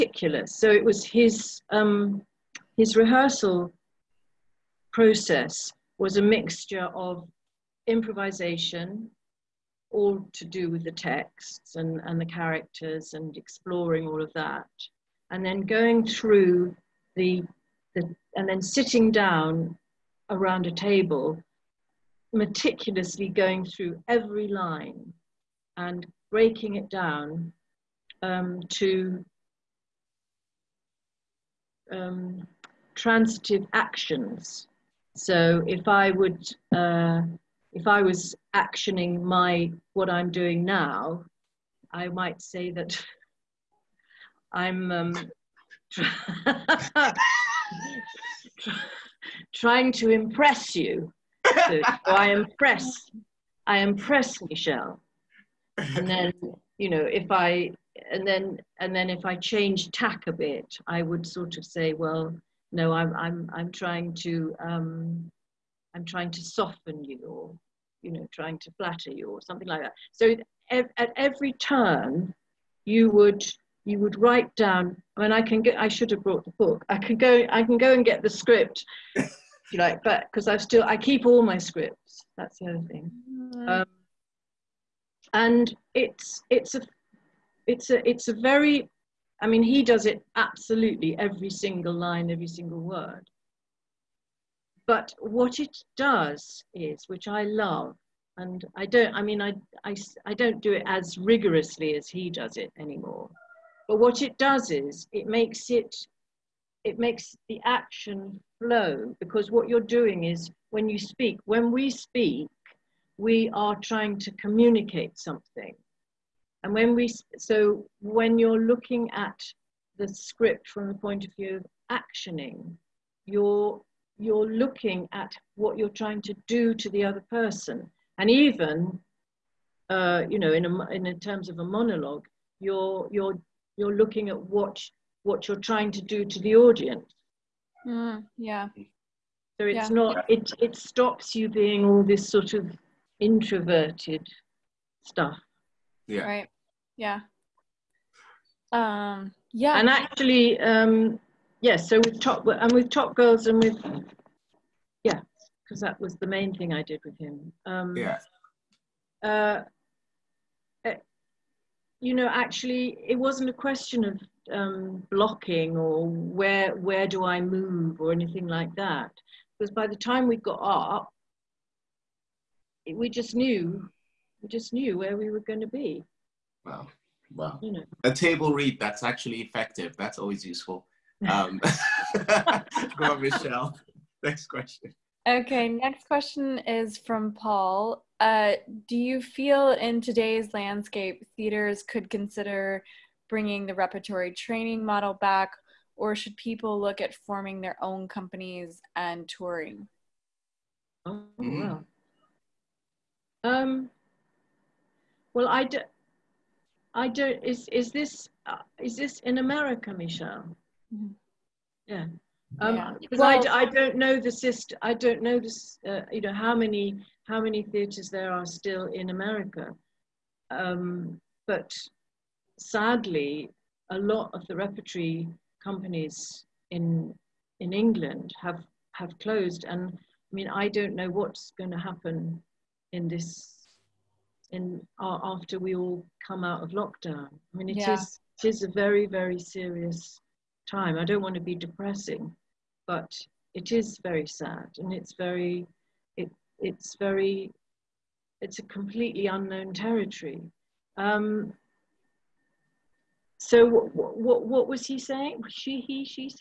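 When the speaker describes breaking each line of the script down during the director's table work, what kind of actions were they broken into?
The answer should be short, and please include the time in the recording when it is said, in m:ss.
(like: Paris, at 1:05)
transitive actions, at 0:32.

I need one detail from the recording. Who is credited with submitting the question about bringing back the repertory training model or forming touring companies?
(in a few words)
Paul.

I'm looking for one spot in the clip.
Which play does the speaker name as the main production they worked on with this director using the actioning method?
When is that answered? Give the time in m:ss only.
2:32.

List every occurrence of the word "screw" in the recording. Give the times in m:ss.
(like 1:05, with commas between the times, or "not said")
not said.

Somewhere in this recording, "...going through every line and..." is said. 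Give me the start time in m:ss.
0:23.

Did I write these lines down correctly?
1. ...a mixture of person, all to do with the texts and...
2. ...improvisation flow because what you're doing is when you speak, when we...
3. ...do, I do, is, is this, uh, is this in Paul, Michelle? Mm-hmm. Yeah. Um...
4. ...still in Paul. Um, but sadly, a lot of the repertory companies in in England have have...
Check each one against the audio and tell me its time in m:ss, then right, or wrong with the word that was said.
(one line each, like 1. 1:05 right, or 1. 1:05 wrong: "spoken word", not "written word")
1. 0:06 wrong: "improvisation", not "person"
2. 1:47 wrong: "action", not "improvisation"
3. 3:25 wrong: "America", not "Paul"
4. 3:38 wrong: "America", not "Paul".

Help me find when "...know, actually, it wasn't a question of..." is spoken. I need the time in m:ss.
2:42.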